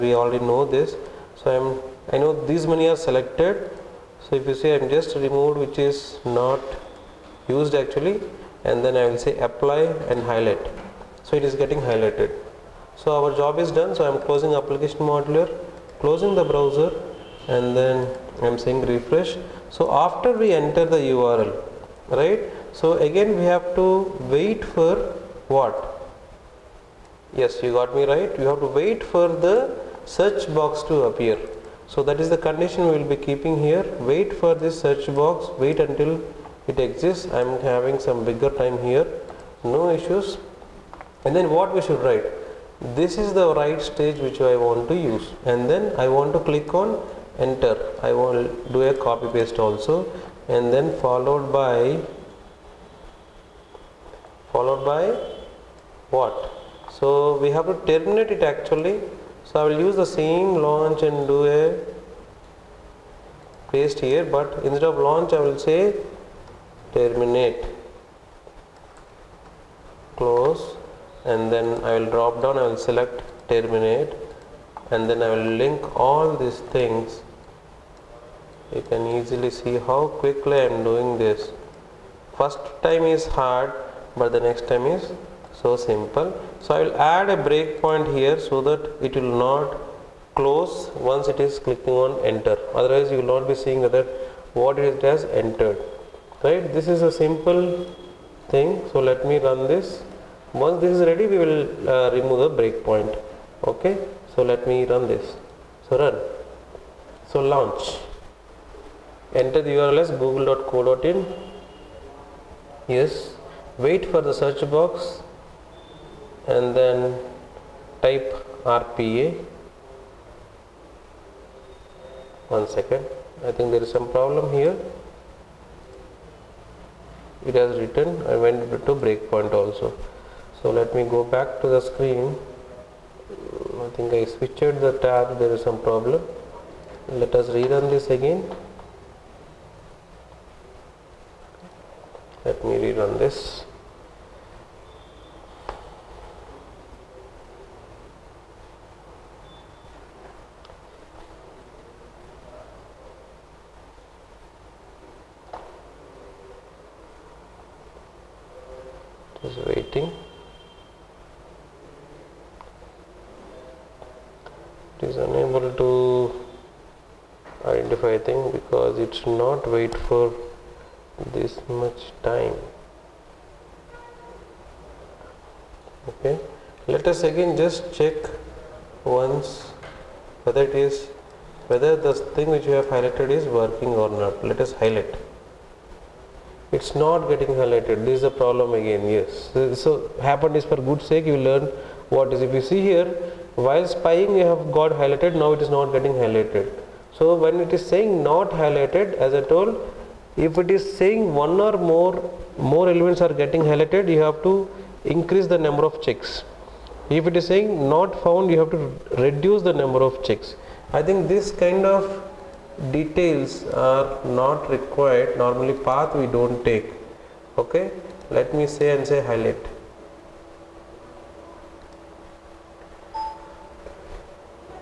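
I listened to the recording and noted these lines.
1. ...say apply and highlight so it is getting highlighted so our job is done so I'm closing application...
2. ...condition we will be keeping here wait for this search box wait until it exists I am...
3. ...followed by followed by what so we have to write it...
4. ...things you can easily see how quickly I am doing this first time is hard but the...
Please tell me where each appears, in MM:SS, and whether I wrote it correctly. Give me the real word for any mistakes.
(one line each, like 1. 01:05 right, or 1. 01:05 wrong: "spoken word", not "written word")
1. 00:09 right
2. 00:32 right
3. 00:50 wrong: "terminate", not "write"
4. 01:16 right.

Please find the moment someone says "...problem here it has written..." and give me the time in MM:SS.
02:04.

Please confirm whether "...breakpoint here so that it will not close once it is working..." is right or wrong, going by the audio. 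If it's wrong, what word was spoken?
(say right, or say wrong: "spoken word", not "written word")
wrong: "clicking", not "working".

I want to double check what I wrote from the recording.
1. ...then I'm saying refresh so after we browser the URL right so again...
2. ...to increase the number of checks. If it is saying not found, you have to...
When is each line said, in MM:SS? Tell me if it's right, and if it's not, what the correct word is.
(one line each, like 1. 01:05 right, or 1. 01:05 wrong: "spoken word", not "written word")
1. 00:17 wrong: "enter", not "browser"
2. 03:24 right.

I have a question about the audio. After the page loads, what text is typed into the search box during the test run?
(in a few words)
rpa.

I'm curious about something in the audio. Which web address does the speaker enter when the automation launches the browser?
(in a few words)
google.co.in.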